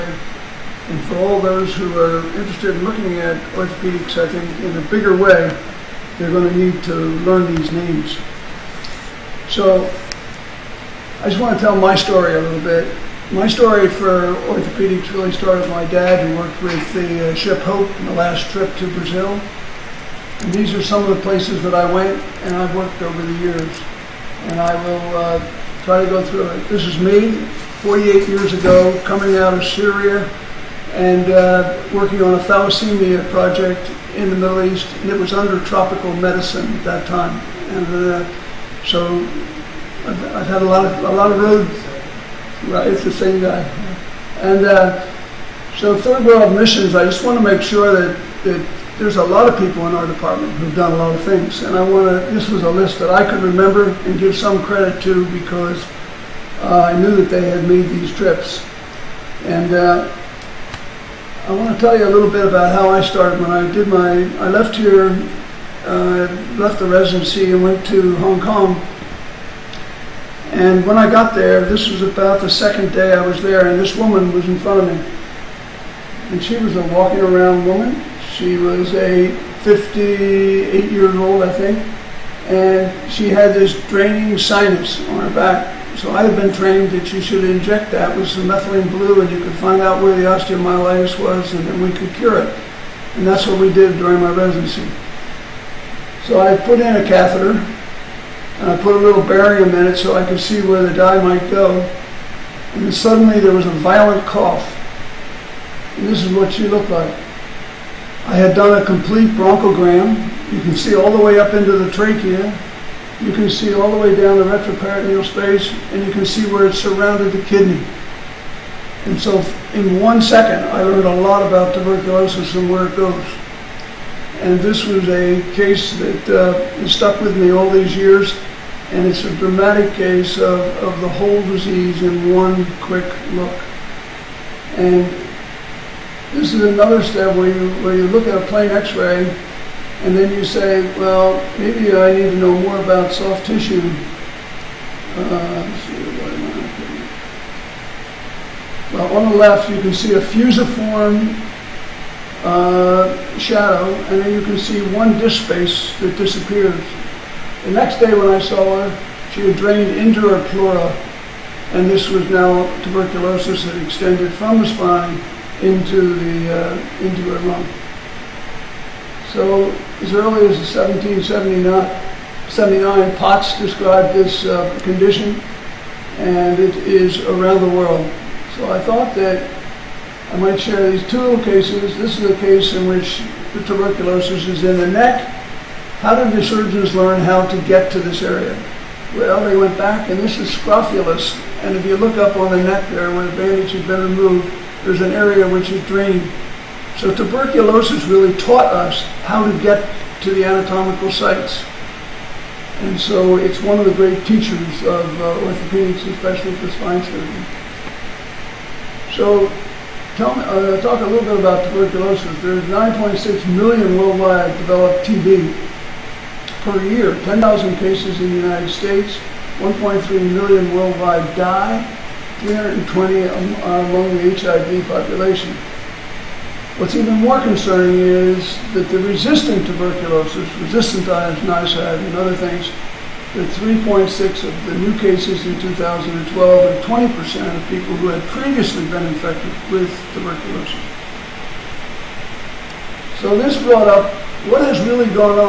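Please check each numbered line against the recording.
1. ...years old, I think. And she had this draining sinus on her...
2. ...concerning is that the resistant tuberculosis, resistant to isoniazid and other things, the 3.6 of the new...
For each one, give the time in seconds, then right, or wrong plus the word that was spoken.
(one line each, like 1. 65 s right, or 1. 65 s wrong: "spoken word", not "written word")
1. 80 s right
2. 227 s right.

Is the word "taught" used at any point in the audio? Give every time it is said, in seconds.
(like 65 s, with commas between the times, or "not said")
198 s.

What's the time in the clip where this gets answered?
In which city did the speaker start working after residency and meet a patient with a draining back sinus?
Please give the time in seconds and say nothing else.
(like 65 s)
68 s.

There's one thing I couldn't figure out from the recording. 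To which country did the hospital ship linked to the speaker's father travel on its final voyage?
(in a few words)
Brazil.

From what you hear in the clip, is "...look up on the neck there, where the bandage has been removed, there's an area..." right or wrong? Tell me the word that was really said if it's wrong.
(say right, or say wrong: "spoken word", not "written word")
right.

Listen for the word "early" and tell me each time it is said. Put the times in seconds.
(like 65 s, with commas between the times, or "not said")
170 s.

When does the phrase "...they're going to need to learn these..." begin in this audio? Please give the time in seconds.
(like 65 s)
6 s.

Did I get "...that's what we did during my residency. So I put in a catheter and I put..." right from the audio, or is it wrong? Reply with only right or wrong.
right.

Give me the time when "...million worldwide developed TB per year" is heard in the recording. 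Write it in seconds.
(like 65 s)
213 s.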